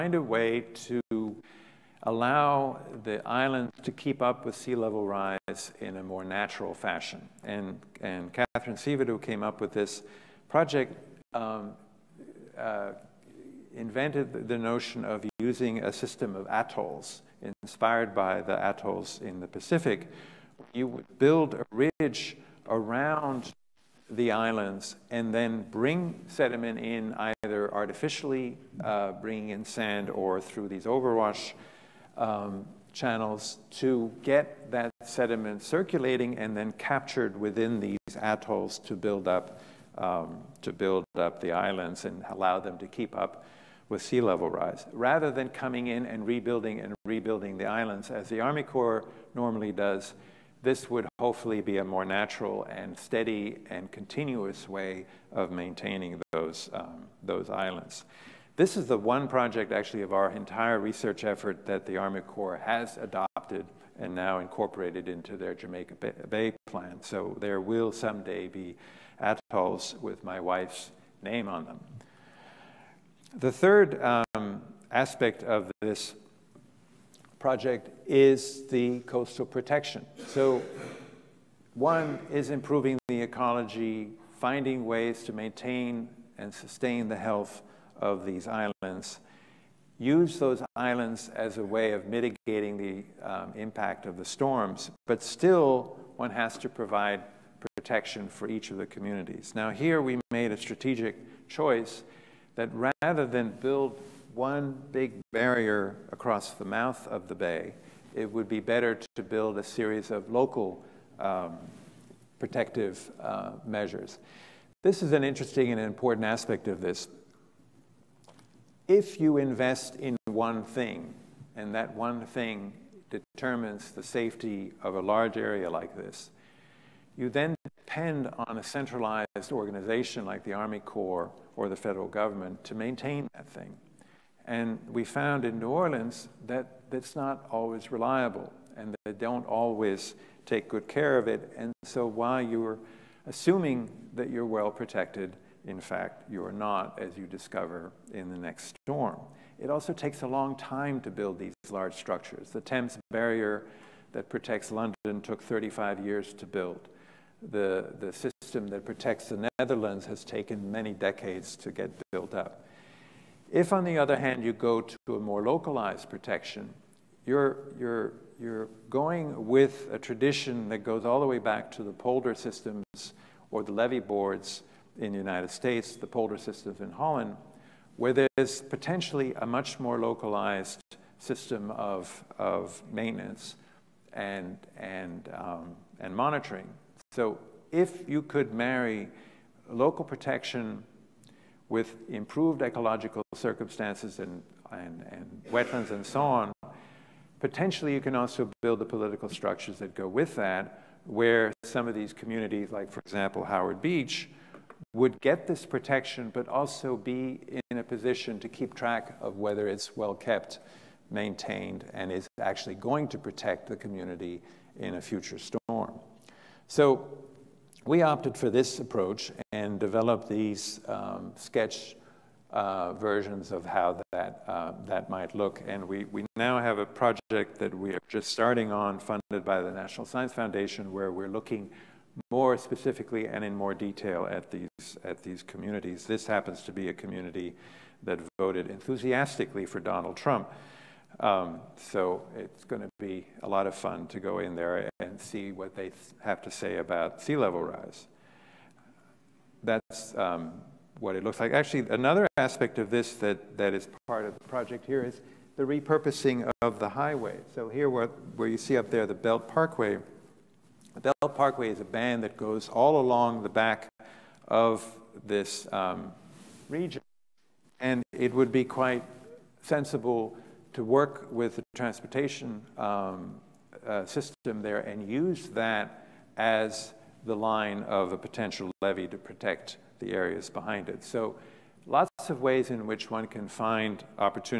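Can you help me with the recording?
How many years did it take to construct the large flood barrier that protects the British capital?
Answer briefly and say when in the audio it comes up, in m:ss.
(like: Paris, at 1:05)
35, at 2:35.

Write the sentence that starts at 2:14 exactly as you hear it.
And we found in New Orleans that that's not always reliable and they don't always take good care of it.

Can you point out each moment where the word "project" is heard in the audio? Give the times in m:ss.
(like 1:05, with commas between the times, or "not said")
0:10, 0:59, 1:17, 3:46, 4:14.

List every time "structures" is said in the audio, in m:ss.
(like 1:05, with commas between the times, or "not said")
2:31, 3:19.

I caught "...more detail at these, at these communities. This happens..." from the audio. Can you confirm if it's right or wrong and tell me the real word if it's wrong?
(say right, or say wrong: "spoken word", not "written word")
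right.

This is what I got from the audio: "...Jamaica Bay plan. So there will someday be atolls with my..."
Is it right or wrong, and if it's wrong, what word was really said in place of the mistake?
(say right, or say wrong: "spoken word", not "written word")
right.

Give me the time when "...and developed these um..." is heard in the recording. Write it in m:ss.
3:39.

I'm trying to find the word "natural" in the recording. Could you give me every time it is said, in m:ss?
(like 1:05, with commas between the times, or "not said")
0:06, 0:52.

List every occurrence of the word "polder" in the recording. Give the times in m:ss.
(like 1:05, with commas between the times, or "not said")
2:51, 2:56.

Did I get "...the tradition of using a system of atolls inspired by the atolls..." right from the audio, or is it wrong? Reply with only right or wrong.
wrong.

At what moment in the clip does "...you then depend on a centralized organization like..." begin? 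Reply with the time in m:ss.
2:07.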